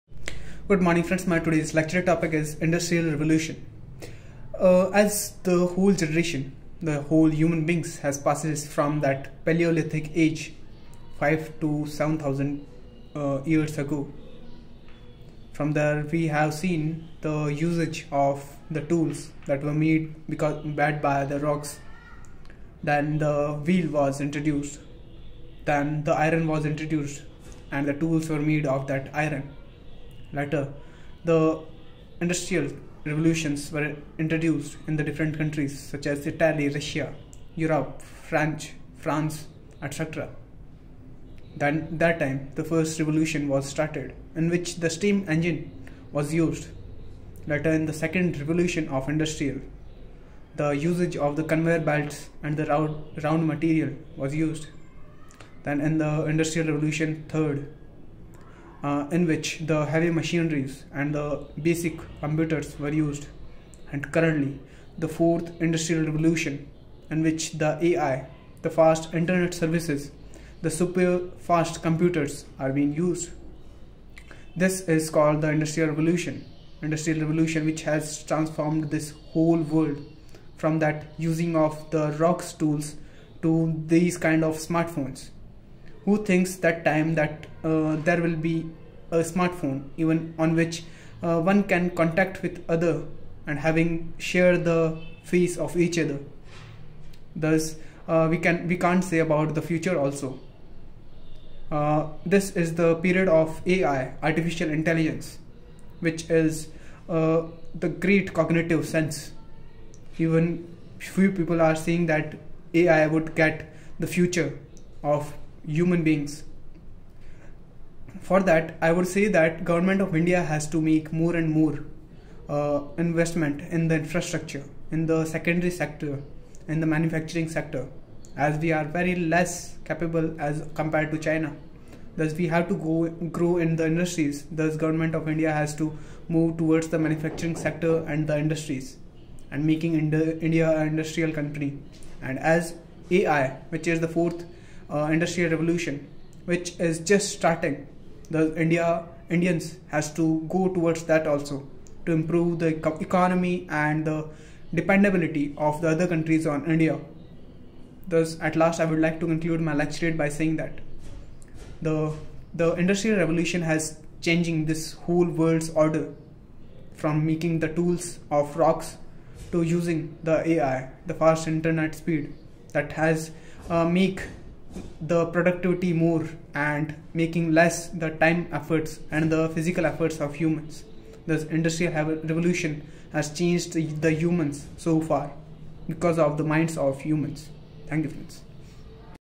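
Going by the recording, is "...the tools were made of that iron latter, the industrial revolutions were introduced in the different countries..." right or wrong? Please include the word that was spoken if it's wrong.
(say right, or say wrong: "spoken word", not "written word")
right.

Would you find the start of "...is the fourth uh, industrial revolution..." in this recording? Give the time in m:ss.
2:23.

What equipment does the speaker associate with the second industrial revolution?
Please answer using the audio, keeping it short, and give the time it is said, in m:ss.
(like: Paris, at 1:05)
Conveyor belts, at 0:51.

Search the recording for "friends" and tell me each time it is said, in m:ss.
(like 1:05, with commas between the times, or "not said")
0:01, 3:08.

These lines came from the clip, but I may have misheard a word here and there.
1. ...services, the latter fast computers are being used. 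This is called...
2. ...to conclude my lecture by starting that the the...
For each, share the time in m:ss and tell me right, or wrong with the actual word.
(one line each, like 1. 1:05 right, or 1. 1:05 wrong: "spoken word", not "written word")
1. 1:09 wrong: "super", not "latter"
2. 2:39 wrong: "saying", not "starting".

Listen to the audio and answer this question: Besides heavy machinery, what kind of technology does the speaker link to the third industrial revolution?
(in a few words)
Basic computers.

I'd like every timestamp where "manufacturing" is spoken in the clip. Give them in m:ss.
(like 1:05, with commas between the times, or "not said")
2:06, 2:16.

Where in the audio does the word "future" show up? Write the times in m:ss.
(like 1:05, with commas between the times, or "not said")
1:39, 1:54.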